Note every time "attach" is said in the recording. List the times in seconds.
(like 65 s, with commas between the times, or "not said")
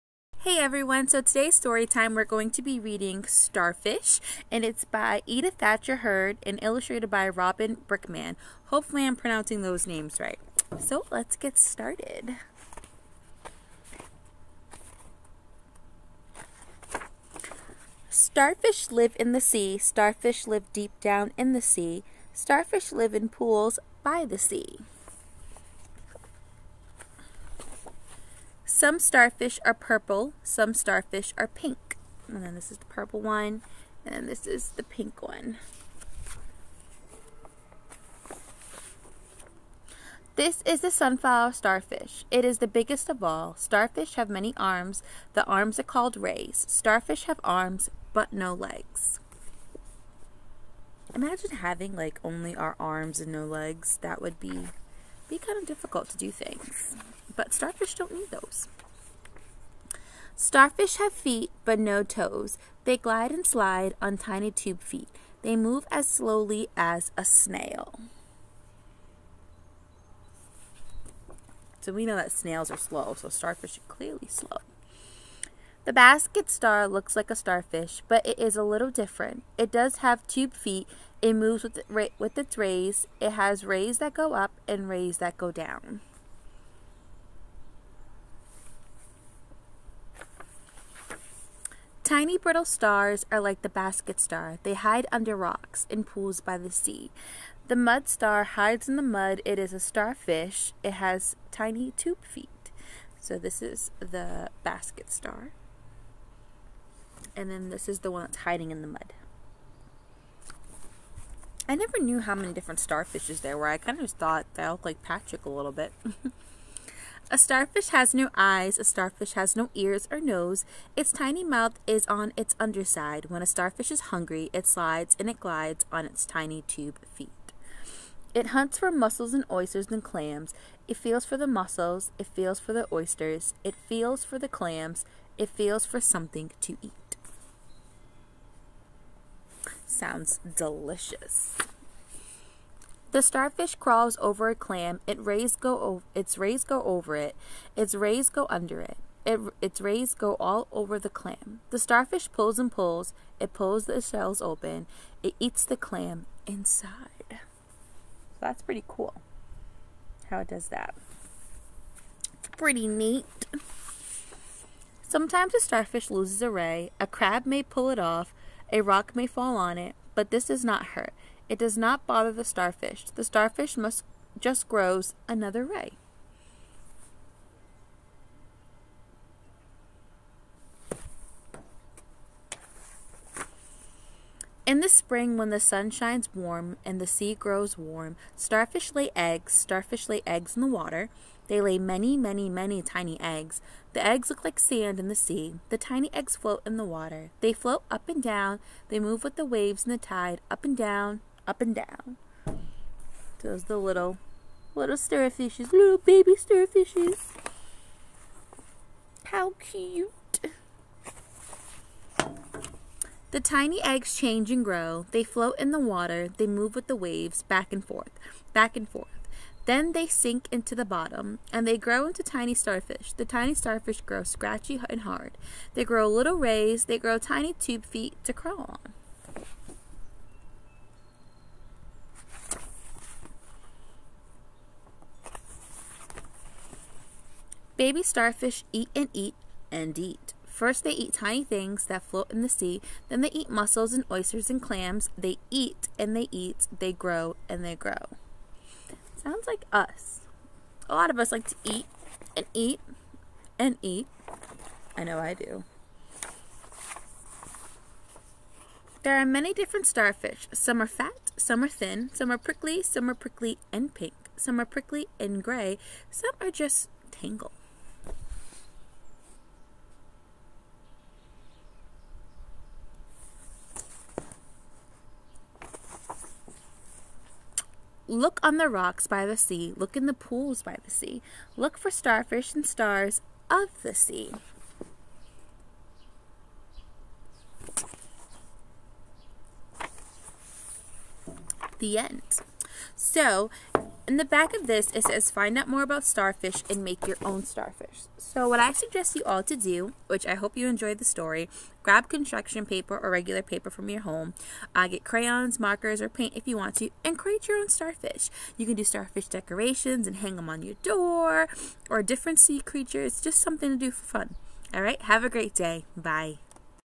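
not said.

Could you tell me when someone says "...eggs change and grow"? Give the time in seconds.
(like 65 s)
213 s.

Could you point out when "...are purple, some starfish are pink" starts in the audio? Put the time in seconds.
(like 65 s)
29 s.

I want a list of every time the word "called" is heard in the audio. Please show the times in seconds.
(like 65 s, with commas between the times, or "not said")
45 s.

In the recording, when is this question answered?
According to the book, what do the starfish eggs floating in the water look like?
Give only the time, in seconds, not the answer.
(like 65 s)
194 s.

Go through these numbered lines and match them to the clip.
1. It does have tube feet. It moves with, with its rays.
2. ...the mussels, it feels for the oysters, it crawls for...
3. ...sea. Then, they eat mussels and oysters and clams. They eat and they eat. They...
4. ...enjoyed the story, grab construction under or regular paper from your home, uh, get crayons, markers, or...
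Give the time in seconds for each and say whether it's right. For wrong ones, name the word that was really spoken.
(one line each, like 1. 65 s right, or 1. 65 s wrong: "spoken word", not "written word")
1. 79 s right
2. 131 s wrong: "feels", not "crawls"
3. 242 s right
4. 300 s wrong: "paper", not "under".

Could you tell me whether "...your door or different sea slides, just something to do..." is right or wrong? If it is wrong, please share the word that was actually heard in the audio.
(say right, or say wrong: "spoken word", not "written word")
wrong: "creatures", not "slides".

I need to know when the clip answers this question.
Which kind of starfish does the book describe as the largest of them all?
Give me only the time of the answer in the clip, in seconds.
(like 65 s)
40 s.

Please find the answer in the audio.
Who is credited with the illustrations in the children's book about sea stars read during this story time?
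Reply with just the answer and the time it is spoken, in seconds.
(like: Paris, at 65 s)
Robin Brickman, at 7 s.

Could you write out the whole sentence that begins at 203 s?
Those the little, little starfishes, little baby starfishes.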